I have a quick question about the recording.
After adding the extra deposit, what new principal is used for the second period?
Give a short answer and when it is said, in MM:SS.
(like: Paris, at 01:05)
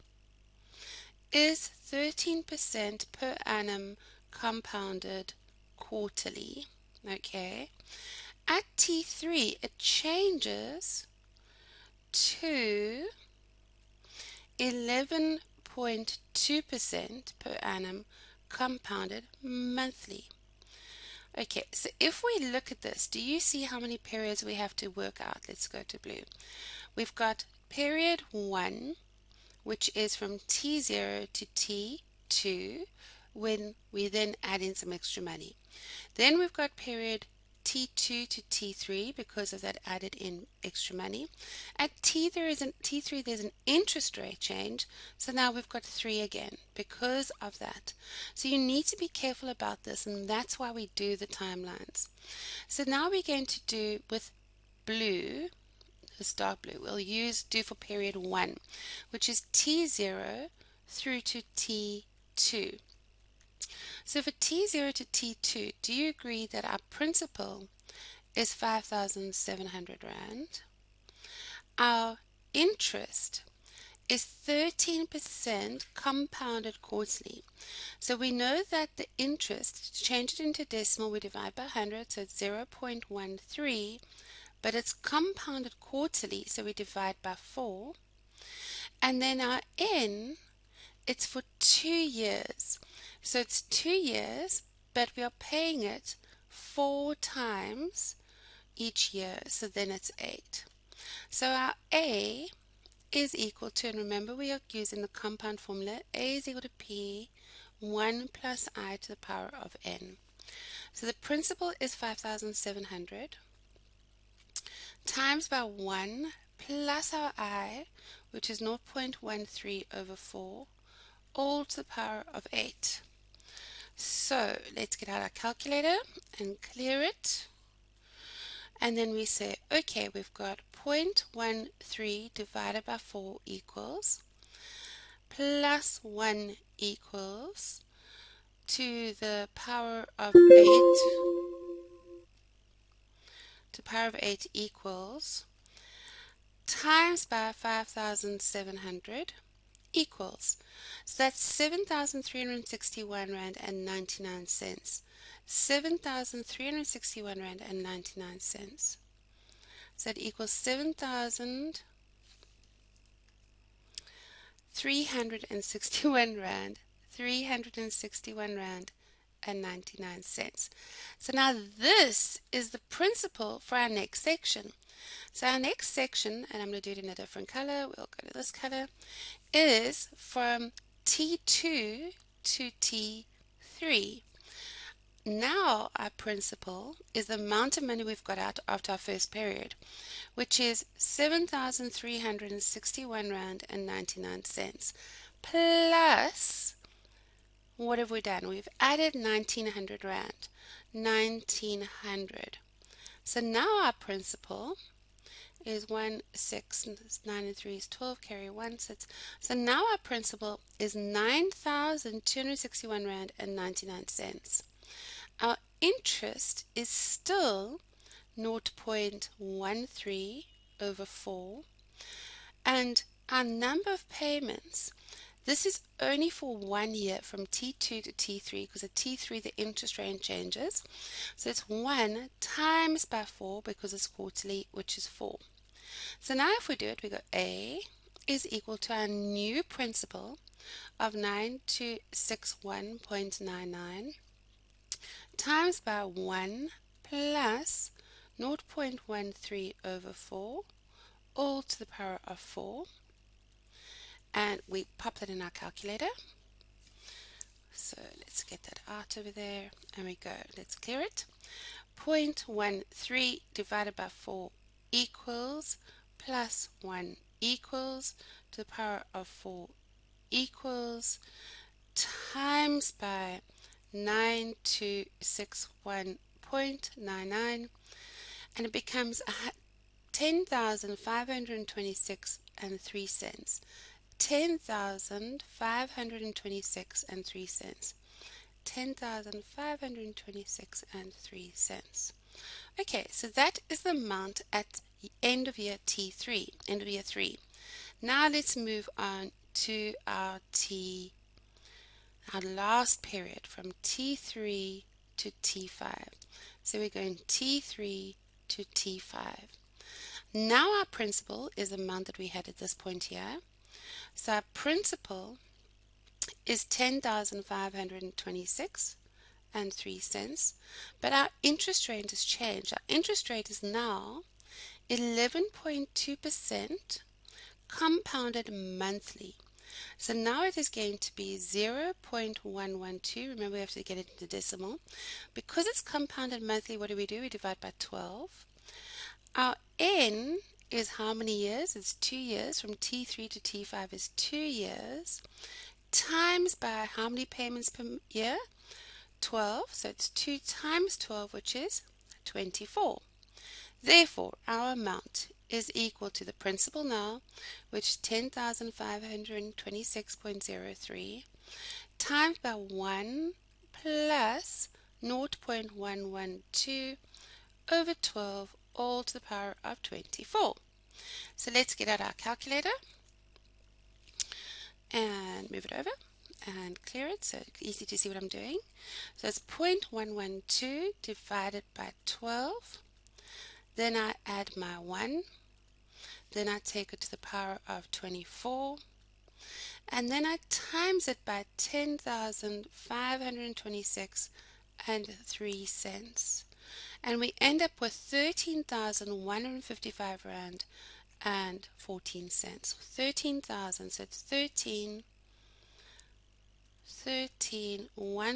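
R9,261.99, at 03:30.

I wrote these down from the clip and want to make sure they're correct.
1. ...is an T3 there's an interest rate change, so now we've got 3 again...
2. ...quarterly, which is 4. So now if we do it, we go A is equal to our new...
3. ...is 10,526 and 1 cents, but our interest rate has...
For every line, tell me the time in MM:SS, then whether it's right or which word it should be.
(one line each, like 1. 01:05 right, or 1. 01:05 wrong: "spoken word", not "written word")
1. 00:42 right
2. 03:54 right
3. 05:16 wrong: "3", not "1".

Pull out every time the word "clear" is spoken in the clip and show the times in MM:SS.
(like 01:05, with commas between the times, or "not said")
02:06, 04:20, 06:16.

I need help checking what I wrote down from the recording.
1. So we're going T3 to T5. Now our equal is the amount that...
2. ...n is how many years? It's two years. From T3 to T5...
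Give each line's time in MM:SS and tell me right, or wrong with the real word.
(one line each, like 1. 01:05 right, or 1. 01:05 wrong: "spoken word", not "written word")
1. 05:06 wrong: "principal", not "equal"
2. 05:39 right.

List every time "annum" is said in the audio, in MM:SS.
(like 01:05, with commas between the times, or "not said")
00:03, 00:17.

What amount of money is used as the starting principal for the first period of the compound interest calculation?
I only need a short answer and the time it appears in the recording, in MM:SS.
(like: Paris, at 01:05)
5,700 Rand, at 01:08.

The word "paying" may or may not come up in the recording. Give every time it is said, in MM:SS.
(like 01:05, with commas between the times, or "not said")
01:35.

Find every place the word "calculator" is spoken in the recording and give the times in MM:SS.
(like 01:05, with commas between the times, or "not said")
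02:05, 04:15, 06:12.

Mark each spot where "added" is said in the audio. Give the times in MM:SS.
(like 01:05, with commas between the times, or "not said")
00:39, 03:18.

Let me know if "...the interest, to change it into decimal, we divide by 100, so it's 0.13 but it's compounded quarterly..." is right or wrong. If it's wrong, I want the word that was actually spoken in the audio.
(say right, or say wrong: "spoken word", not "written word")
right.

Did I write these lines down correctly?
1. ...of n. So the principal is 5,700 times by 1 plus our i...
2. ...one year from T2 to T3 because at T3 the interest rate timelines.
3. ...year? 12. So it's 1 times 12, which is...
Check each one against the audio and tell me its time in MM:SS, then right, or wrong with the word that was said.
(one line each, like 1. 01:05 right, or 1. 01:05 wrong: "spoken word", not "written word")
1. 01:49 right
2. 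03:46 wrong: "changes", not "timelines"
3. 05:48 wrong: "2", not "1".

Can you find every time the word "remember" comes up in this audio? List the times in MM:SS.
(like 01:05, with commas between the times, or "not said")
01:43, 05:33.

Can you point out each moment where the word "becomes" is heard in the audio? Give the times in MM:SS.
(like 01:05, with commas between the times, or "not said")
04:38.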